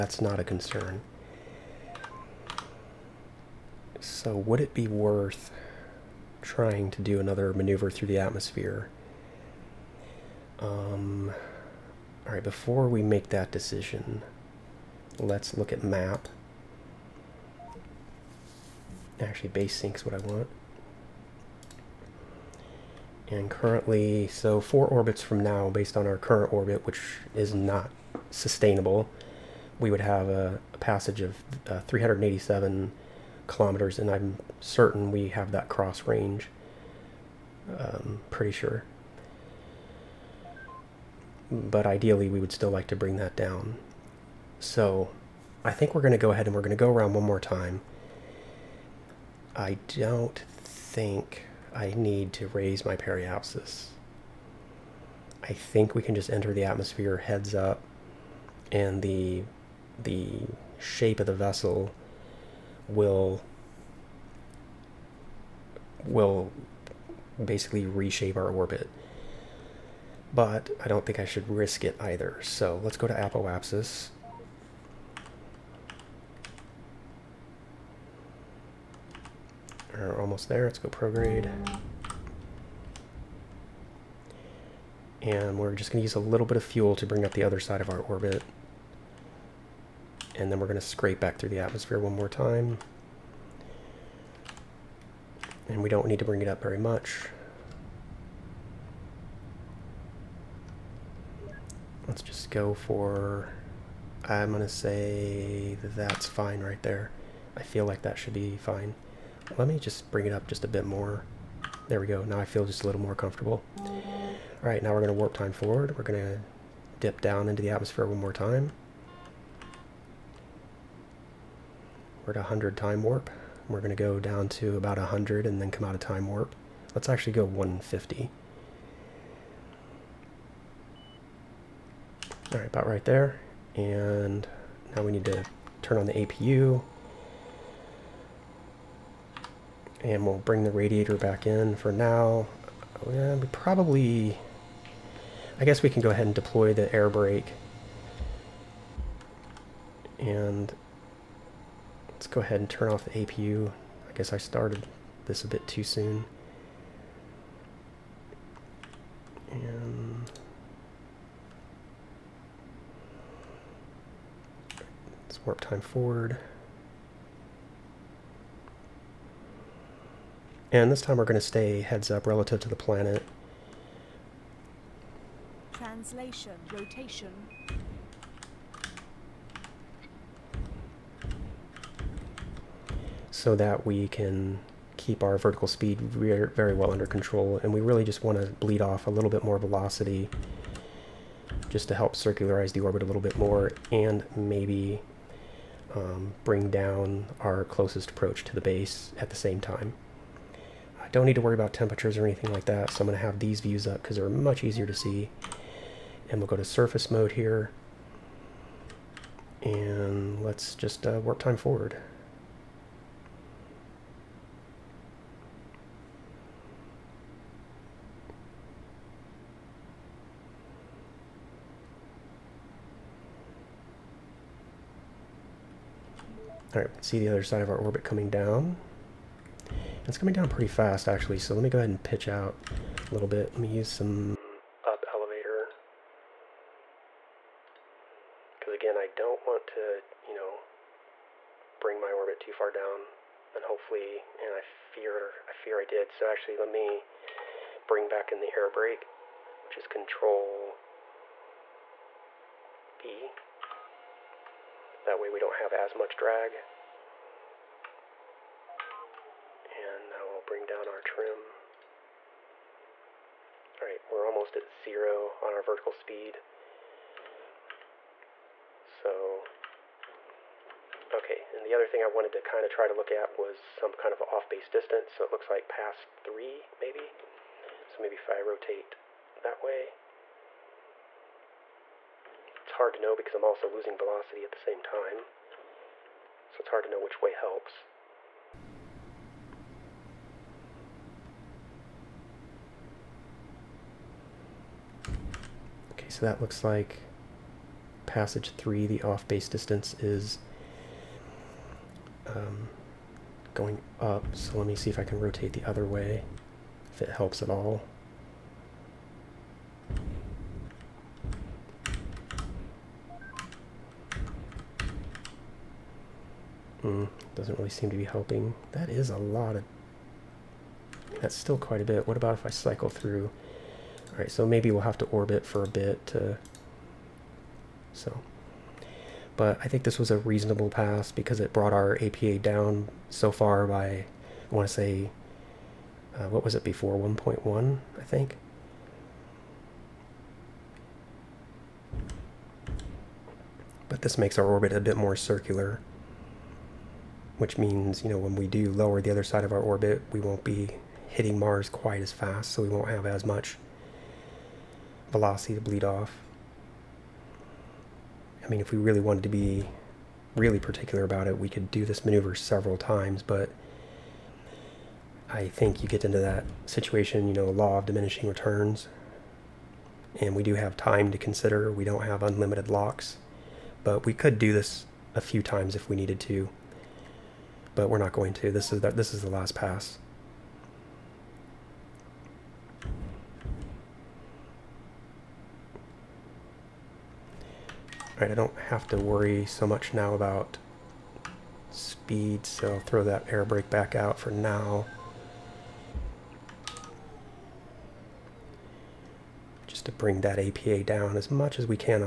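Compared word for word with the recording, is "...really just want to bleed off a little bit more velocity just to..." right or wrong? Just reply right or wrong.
right.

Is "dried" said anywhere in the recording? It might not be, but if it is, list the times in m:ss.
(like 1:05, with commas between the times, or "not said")
not said.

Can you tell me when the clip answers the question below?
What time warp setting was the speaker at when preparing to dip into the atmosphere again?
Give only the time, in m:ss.
2:02.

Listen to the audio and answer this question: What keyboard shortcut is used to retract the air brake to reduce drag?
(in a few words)
Control B.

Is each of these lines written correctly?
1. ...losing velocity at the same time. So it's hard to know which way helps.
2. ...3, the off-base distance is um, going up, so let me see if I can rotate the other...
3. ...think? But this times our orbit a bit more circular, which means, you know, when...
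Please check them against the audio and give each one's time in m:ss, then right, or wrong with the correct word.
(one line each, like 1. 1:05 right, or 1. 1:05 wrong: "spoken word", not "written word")
1. 4:43 right
2. 4:58 right
3. 5:38 wrong: "makes", not "times".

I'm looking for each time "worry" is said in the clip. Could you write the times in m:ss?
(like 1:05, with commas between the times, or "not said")
3:21, 6:28.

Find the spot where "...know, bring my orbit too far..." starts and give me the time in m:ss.
4:00.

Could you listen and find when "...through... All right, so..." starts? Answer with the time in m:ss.
5:22.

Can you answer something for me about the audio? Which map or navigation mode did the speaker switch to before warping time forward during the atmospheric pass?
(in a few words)
surface mode.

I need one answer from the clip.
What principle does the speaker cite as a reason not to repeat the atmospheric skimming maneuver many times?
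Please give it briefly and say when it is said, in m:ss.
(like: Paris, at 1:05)
law of diminishing returns, at 6:07.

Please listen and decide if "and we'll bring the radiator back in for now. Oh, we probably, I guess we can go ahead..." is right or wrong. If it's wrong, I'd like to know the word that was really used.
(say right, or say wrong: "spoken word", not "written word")
right.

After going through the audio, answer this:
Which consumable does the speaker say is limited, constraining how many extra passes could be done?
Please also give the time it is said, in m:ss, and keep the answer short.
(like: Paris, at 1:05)
LOX, at 6:12.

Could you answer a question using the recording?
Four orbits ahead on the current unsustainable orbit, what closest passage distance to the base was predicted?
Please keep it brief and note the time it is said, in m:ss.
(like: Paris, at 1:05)
387 kilometers, at 0:31.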